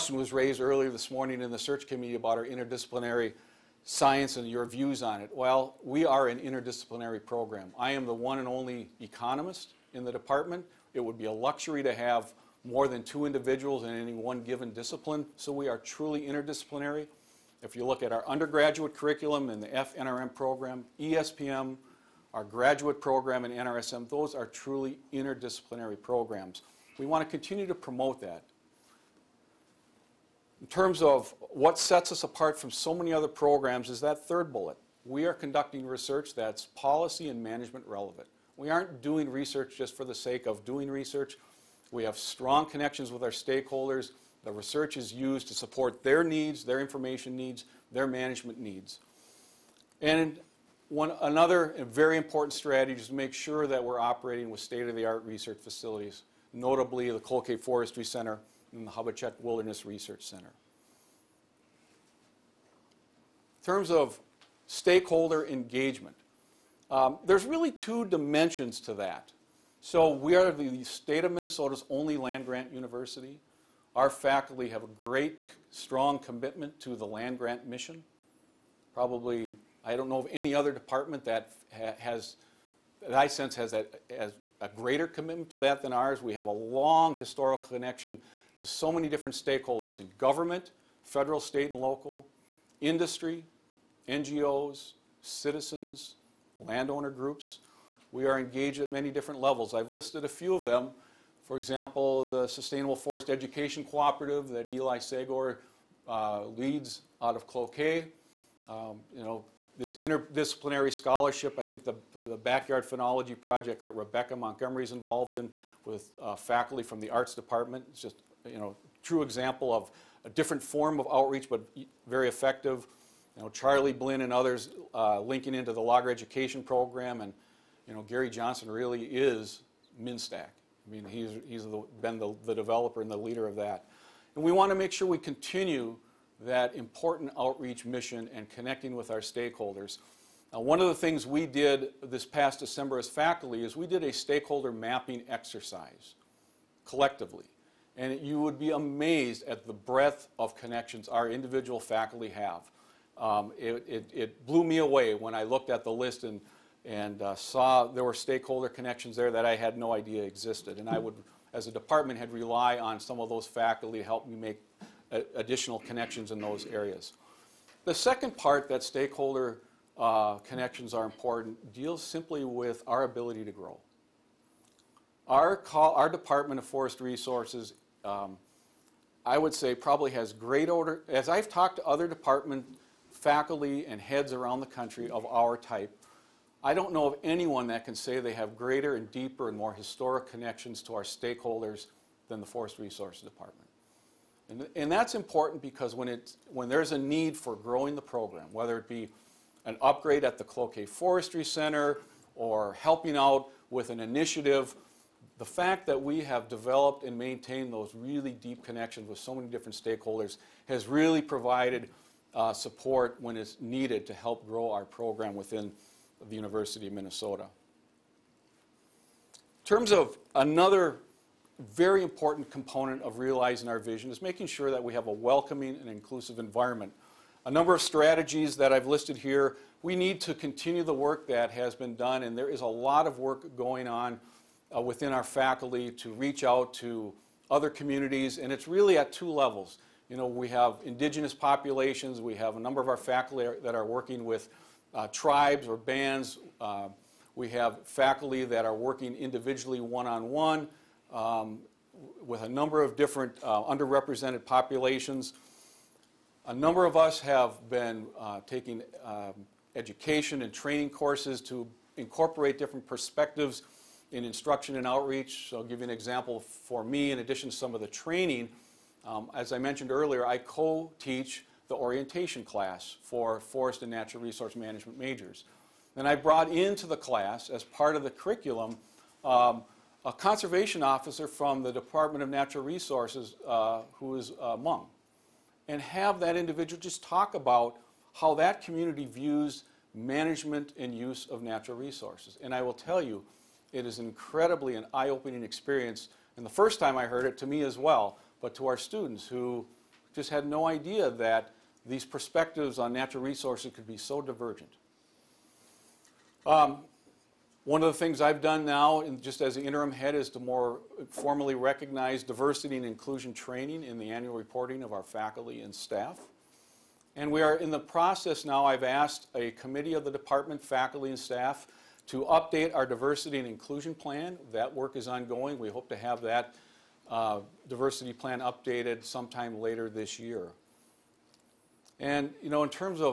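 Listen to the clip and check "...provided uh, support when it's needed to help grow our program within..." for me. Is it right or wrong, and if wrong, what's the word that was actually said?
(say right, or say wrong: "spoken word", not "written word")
right.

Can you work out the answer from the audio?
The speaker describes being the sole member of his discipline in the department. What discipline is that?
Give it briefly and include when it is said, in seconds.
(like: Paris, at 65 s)
economist, at 8 s.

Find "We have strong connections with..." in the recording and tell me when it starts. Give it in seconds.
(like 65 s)
41 s.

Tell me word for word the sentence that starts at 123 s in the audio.
You know, Charlie Blinn and others uh, linking into the Logger Education Program, and you know, Gary Johnson really is MinStack.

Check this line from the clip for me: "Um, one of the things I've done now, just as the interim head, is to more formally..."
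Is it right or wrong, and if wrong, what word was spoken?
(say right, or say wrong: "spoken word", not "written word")
right.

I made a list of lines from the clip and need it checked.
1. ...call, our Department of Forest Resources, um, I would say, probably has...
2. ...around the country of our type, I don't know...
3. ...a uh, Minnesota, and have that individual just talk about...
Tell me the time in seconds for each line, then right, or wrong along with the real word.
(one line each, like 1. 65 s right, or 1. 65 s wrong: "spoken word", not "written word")
1. 175 s right
2. 184 s right
3. 284 s wrong: "Hmong", not "Minnesota".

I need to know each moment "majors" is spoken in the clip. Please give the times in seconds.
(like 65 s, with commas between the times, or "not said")
274 s.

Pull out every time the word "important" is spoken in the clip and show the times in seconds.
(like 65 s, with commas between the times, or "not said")
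52 s, 136 s, 171 s, 195 s, 222 s.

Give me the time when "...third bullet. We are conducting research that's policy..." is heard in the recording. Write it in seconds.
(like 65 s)
34 s.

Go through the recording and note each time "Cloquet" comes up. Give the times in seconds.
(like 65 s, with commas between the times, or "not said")
57 s, 107 s, 200 s.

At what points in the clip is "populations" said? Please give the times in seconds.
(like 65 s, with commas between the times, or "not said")
241 s, 254 s.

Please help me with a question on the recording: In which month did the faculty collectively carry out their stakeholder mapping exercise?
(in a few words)
December.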